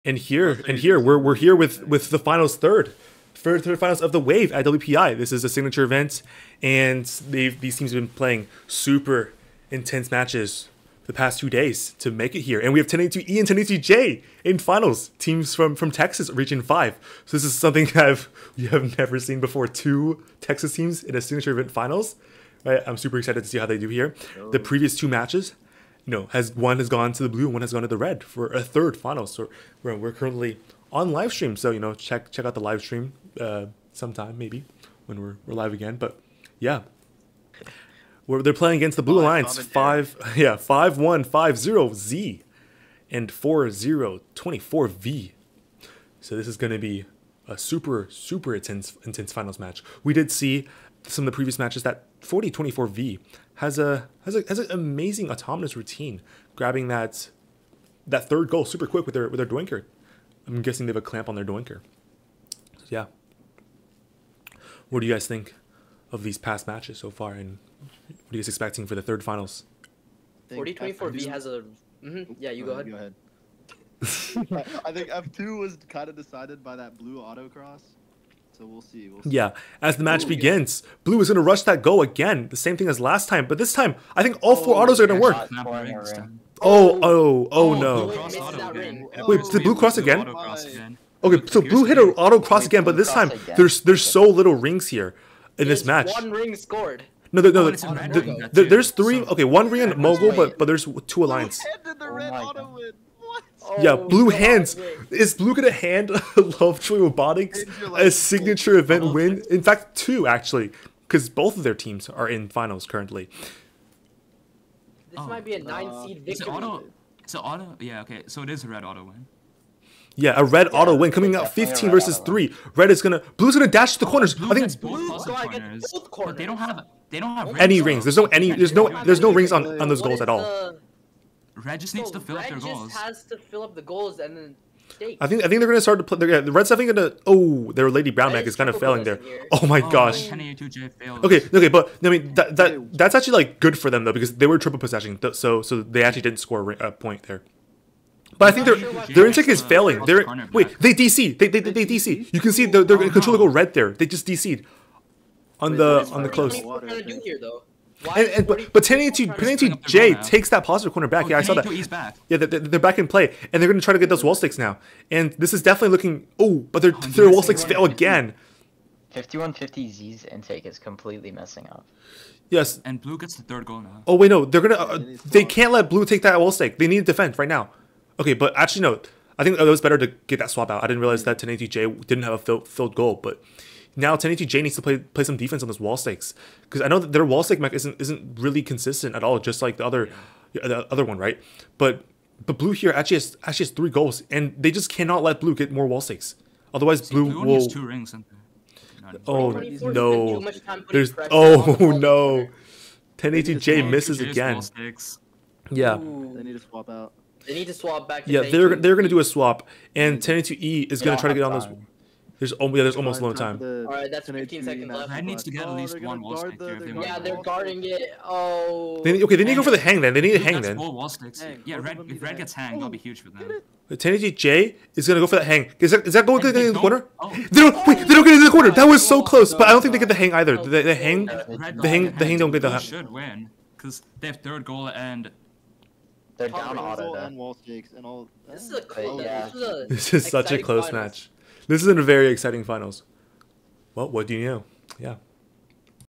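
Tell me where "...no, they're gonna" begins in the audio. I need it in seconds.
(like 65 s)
174 s.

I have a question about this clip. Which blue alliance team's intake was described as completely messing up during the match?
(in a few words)
5150Z.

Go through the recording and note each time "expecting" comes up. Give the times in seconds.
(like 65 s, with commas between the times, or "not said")
68 s.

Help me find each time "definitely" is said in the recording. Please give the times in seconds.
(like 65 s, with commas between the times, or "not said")
136 s, 165 s.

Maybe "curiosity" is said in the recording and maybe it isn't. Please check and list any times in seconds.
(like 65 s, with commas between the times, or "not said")
not said.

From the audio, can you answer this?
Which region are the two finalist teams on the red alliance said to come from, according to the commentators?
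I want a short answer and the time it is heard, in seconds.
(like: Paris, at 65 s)
Region 5, at 16 s.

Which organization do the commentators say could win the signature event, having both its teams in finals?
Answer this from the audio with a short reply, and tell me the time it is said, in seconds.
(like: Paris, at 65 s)
Lovejoy Robotics, at 106 s.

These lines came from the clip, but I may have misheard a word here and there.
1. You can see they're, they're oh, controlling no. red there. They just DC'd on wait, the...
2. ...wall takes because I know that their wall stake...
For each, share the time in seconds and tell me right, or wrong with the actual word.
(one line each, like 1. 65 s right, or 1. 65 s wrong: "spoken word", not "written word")
1. 152 s right
2. 185 s wrong: "stakes", not "takes".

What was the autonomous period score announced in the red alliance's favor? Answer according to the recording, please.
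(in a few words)
15 versus 3.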